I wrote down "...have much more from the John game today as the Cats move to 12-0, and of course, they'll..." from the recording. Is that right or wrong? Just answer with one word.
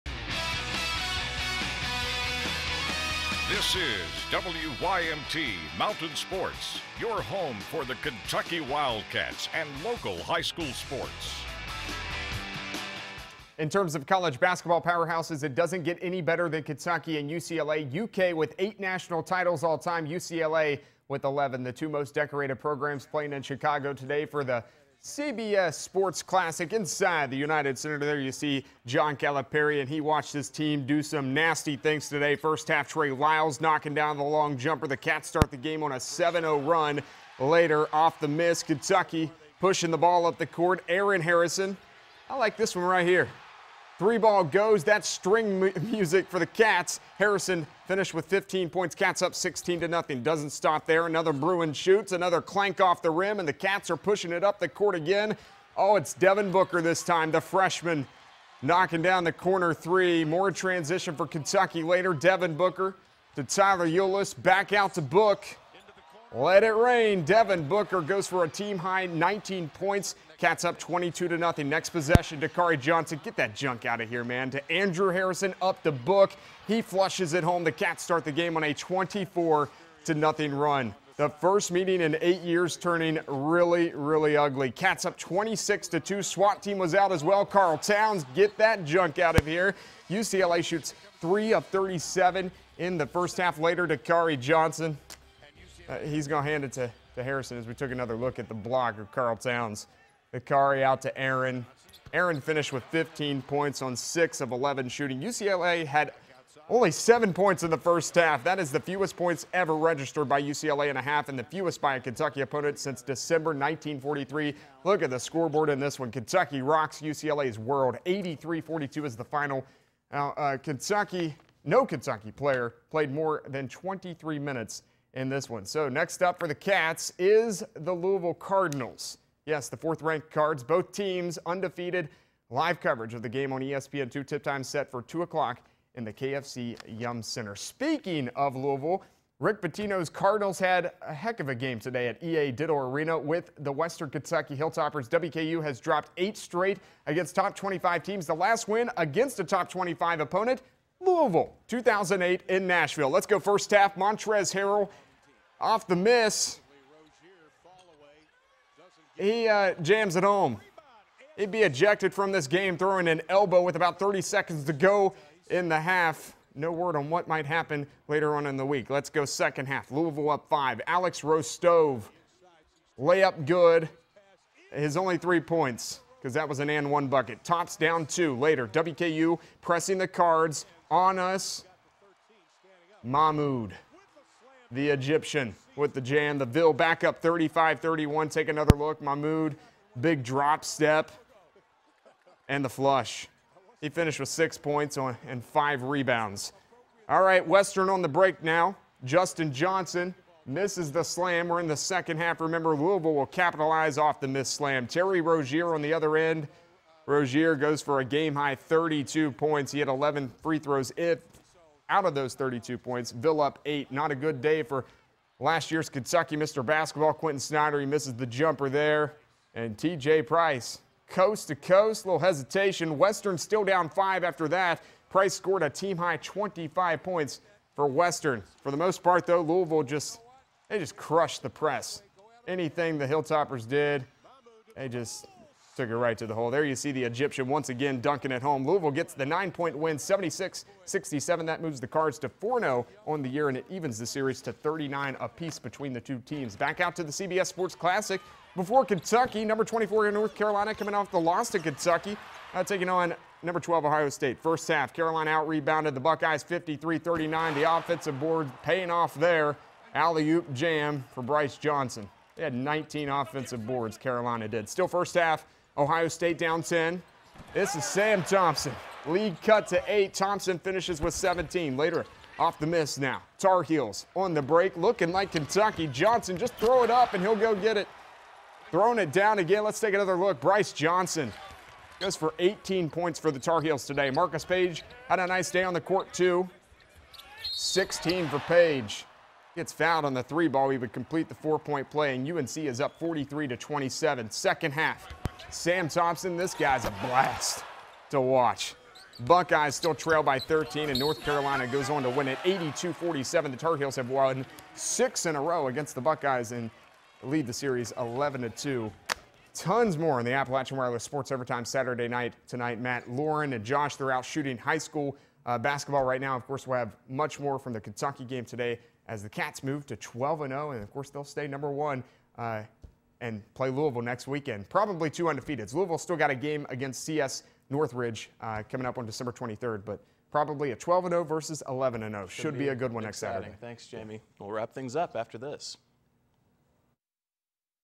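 wrong.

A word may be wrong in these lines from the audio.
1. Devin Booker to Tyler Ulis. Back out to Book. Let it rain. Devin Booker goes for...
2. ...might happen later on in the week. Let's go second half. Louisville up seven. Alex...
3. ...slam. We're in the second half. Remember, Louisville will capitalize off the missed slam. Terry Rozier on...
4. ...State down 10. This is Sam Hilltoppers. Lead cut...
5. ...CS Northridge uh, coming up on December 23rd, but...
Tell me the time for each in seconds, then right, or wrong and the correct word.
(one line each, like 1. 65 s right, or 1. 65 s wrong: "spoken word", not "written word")
1. 62 s right
2. 167 s wrong: "five", not "seven"
3. 201 s right
4. 266 s wrong: "Thompson", not "Hilltoppers"
5. 327 s right.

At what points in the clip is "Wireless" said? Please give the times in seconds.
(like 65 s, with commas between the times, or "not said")
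310 s.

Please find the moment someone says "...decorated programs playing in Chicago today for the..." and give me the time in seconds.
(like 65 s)
22 s.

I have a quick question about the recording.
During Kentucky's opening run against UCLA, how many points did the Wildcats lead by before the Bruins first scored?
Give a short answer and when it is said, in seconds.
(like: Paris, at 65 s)
24, at 78 s.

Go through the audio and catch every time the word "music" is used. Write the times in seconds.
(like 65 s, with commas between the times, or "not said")
45 s.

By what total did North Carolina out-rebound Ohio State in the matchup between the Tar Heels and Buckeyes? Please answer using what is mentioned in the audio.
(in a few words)
53-39.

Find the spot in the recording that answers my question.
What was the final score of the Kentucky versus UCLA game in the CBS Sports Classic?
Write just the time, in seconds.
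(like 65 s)
118 s.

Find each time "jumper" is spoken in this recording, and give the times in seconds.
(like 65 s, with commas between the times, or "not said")
34 s, 218 s.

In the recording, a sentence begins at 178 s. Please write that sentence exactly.
WKU pressing the cards on us.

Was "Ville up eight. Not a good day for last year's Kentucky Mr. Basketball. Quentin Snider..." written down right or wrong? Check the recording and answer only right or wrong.
right.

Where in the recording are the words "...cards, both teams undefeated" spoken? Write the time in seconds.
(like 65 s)
130 s.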